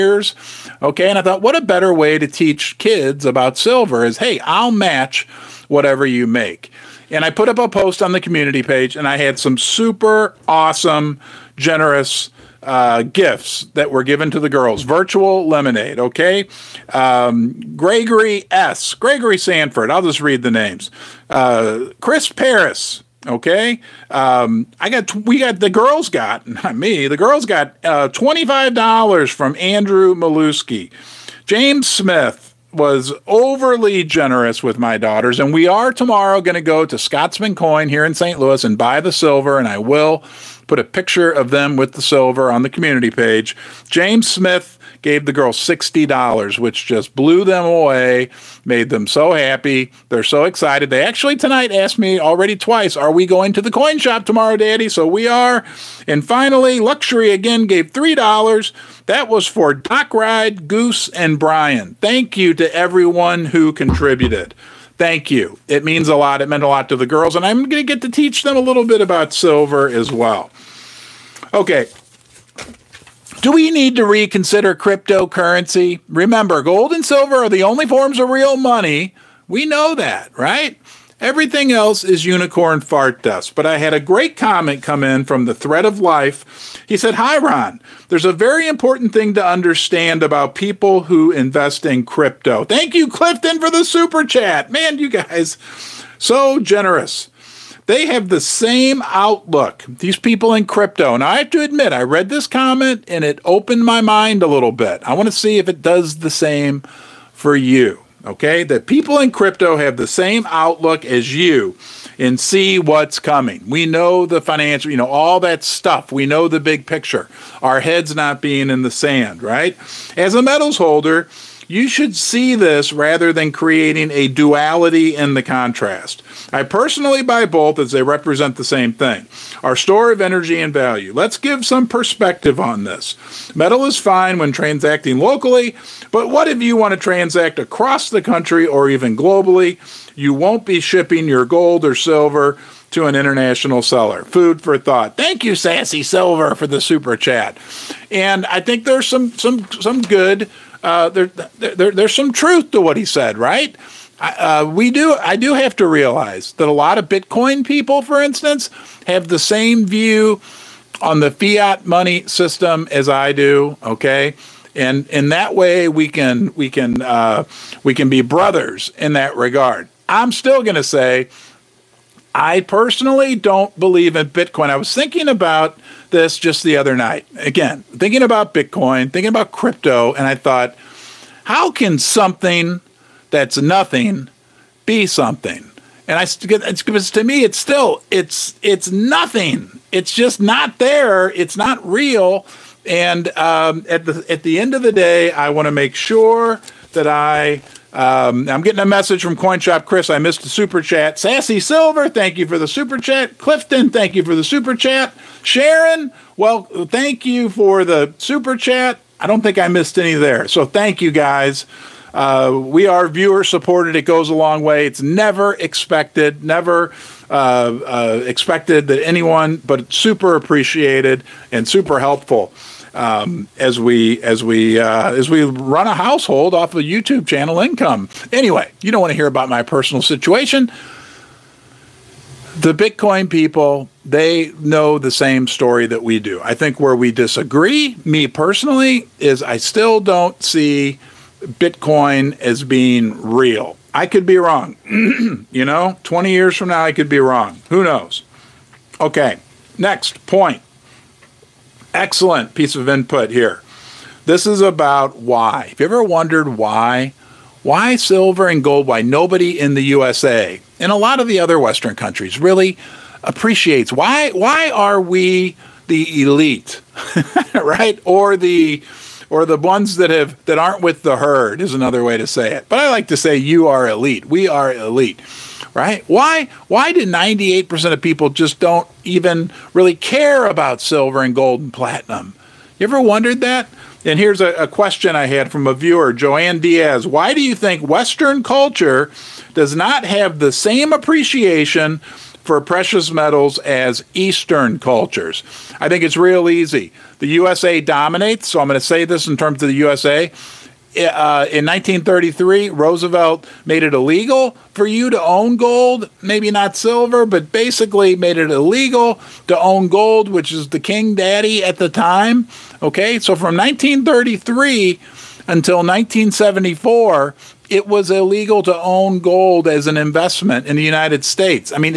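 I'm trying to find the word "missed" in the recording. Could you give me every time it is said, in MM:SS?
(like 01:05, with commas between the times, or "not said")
03:20, 03:29.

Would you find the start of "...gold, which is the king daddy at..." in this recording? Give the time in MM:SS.
05:09.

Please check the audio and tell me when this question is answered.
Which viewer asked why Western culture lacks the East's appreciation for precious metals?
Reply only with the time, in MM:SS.
04:46.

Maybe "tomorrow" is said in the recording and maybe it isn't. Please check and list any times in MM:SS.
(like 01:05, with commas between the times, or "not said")
00:35, 00:54.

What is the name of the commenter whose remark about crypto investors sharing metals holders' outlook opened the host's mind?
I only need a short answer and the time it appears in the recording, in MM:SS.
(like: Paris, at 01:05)
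Thread of Life, at 01:25.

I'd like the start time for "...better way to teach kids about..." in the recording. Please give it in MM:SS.
00:01.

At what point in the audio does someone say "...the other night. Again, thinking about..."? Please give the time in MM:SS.
02:56.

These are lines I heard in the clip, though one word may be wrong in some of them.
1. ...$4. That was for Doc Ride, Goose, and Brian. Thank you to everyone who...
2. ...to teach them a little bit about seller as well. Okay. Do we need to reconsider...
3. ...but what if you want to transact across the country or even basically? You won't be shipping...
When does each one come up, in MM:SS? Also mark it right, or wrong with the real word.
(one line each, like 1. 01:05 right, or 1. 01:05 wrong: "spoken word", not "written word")
1. 00:57 wrong: "3", not "4"
2. 01:08 wrong: "silver", not "seller"
3. 02:16 wrong: "globally", not "basically".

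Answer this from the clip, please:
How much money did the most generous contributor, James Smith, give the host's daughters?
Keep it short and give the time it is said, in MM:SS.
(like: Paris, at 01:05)
$60, at 00:45.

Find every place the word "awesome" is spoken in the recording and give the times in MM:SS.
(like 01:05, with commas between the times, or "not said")
00:10.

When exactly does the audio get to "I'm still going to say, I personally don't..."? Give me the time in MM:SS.
02:50.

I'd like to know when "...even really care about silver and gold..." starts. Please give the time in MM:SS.
04:39.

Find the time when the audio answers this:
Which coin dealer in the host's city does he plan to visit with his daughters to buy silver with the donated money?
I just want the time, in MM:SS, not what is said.
00:36.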